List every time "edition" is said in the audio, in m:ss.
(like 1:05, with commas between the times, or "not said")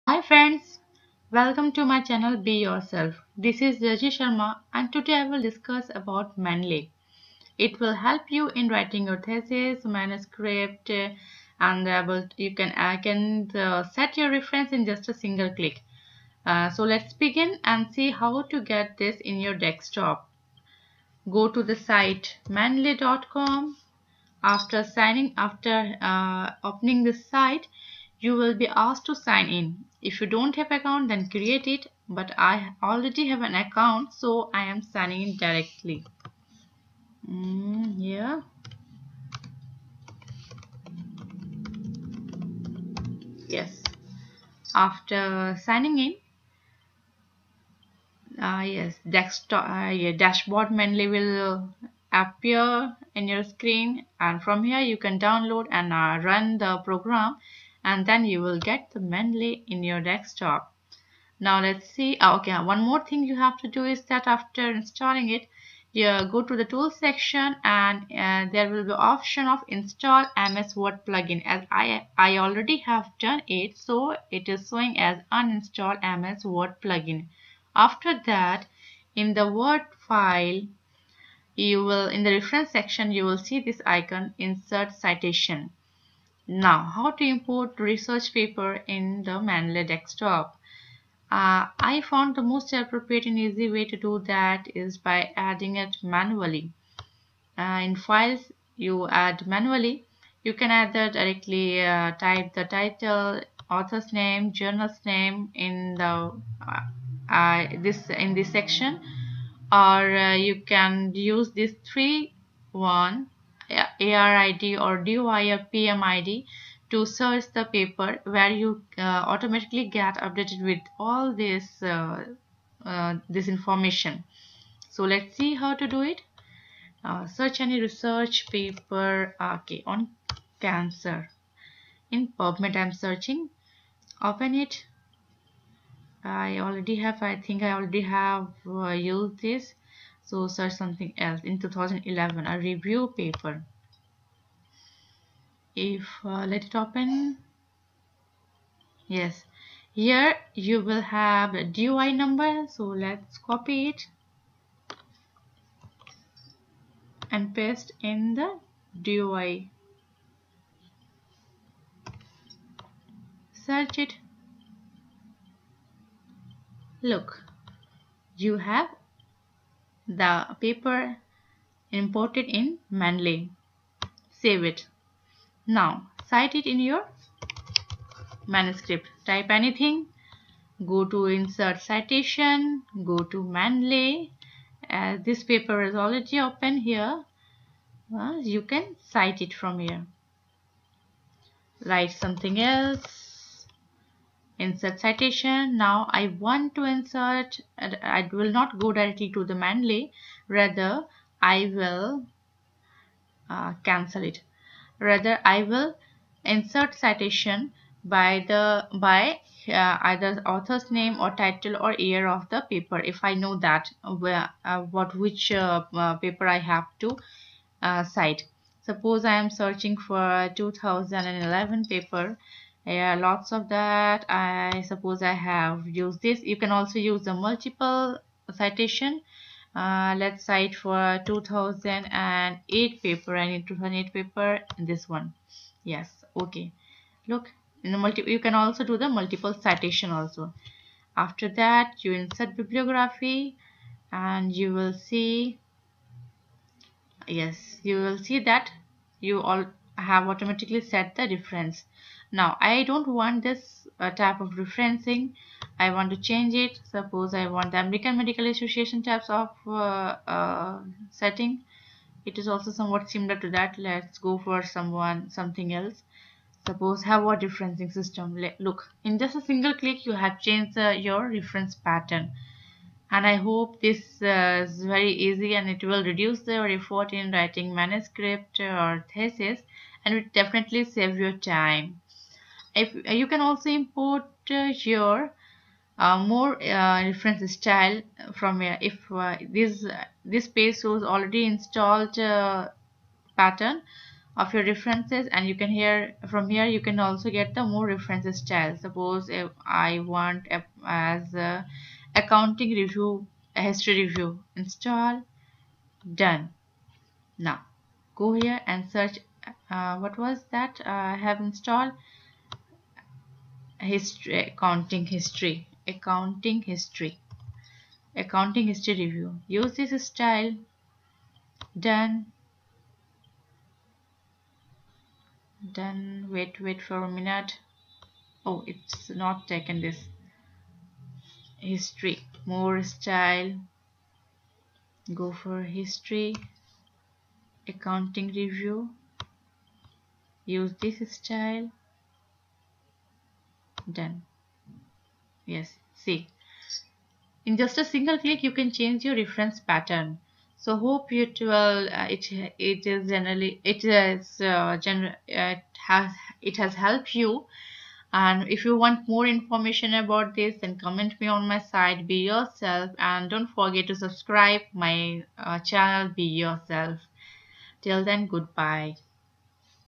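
not said.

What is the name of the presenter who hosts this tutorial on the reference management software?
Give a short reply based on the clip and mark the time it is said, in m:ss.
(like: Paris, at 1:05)
Raji Sharma, at 0:03.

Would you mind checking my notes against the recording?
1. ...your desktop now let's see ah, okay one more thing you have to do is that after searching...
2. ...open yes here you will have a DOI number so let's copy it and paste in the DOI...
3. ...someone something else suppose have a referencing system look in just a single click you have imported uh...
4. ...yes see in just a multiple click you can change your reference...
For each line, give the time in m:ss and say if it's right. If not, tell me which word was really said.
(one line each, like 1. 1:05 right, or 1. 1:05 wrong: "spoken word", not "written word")
1. 0:59 wrong: "installing", not "searching"
2. 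2:26 right
3. 4:24 wrong: "changed", not "imported"
4. 5:45 wrong: "single", not "multiple".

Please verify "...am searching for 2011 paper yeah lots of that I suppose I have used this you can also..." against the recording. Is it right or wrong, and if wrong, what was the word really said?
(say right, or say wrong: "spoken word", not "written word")
right.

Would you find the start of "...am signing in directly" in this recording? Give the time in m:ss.
0:34.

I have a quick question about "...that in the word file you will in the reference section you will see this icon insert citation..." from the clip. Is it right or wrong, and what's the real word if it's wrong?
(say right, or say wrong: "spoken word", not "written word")
right.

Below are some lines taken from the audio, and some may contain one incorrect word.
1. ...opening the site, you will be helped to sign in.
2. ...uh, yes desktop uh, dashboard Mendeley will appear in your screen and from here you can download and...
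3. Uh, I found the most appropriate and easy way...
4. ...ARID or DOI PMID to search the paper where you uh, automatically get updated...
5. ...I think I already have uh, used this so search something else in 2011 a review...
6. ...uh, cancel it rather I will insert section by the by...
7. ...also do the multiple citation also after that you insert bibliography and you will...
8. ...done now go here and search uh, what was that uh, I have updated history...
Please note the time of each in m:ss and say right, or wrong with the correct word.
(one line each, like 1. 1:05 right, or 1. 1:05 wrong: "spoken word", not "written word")
1. 0:26 wrong: "asked", not "helped"
2. 0:48 right
3. 1:31 right
4. 1:54 right
5. 2:17 right
6. 3:23 wrong: "citation", not "section"
7. 3:58 right
8. 5:06 wrong: "installed", not "updated".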